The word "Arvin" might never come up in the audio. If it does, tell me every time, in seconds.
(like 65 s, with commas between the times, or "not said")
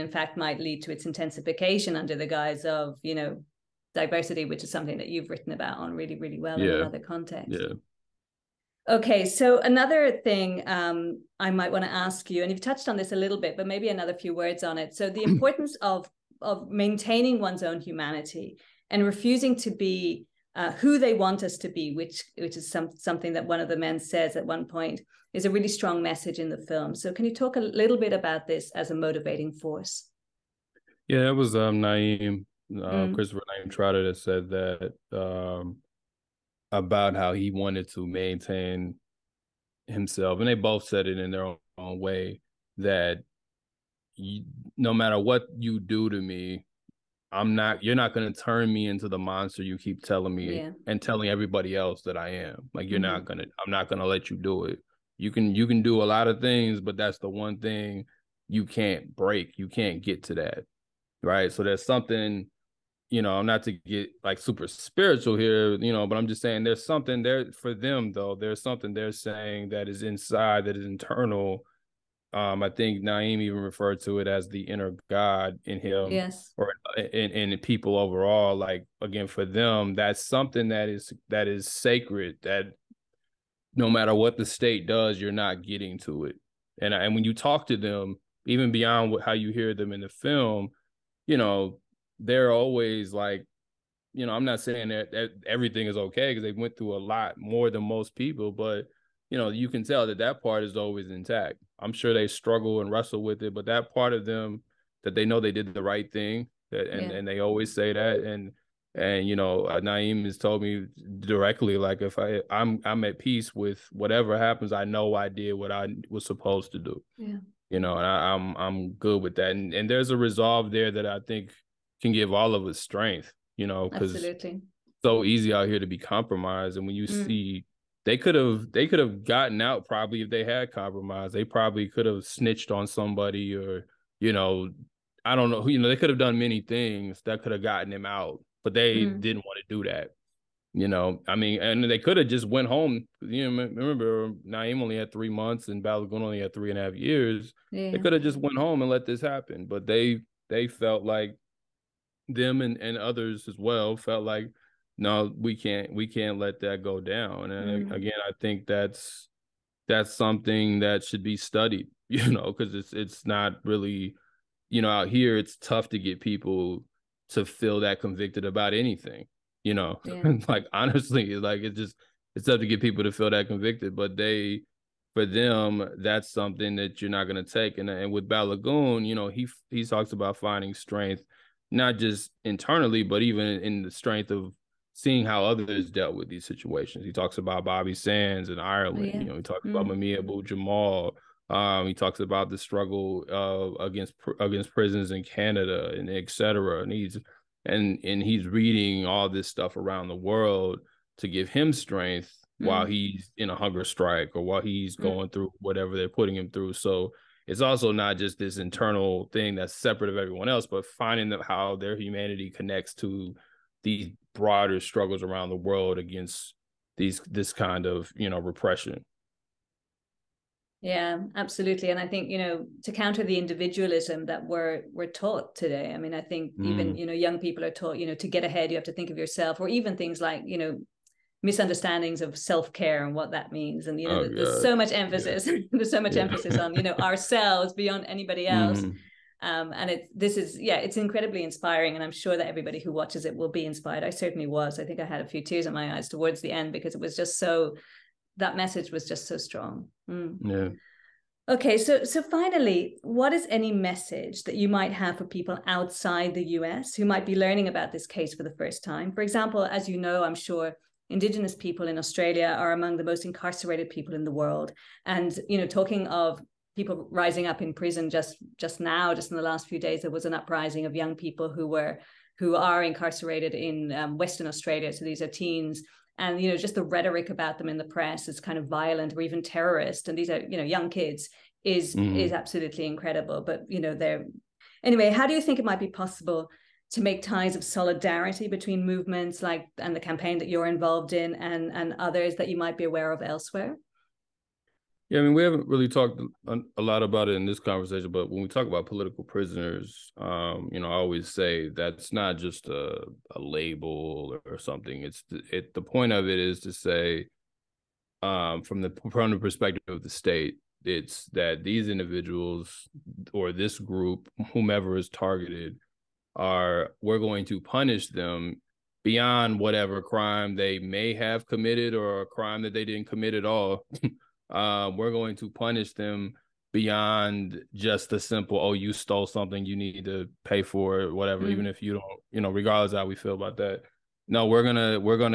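not said.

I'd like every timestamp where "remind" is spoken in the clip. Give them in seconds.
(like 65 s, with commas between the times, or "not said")
not said.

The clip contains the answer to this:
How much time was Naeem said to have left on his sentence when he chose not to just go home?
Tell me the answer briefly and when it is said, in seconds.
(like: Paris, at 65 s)
3 months, at 145 s.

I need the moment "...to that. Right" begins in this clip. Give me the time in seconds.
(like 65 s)
60 s.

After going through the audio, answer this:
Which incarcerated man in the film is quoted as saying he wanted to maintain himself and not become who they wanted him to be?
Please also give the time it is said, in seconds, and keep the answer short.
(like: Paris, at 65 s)
Christopher Naeem Trotter, at 33 s.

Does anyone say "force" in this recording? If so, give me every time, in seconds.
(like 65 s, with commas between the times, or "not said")
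29 s.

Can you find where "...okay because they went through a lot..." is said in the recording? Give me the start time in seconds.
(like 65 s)
95 s.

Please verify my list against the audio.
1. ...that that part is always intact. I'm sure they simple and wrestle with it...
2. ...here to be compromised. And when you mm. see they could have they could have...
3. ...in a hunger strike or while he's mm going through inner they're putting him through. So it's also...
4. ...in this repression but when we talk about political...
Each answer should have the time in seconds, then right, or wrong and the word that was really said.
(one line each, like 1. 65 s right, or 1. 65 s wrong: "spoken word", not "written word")
1. 100 s wrong: "struggle", not "simple"
2. 125 s right
3. 203 s wrong: "whatever", not "inner"
4. 297 s wrong: "conversation", not "repression".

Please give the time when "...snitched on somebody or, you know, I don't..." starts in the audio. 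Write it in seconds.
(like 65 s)
132 s.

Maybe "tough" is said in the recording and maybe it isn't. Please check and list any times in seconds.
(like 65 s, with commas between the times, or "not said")
165 s, 172 s.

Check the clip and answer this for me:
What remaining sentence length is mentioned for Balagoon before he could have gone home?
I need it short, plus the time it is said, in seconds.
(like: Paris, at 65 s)
3.5 years, at 146 s.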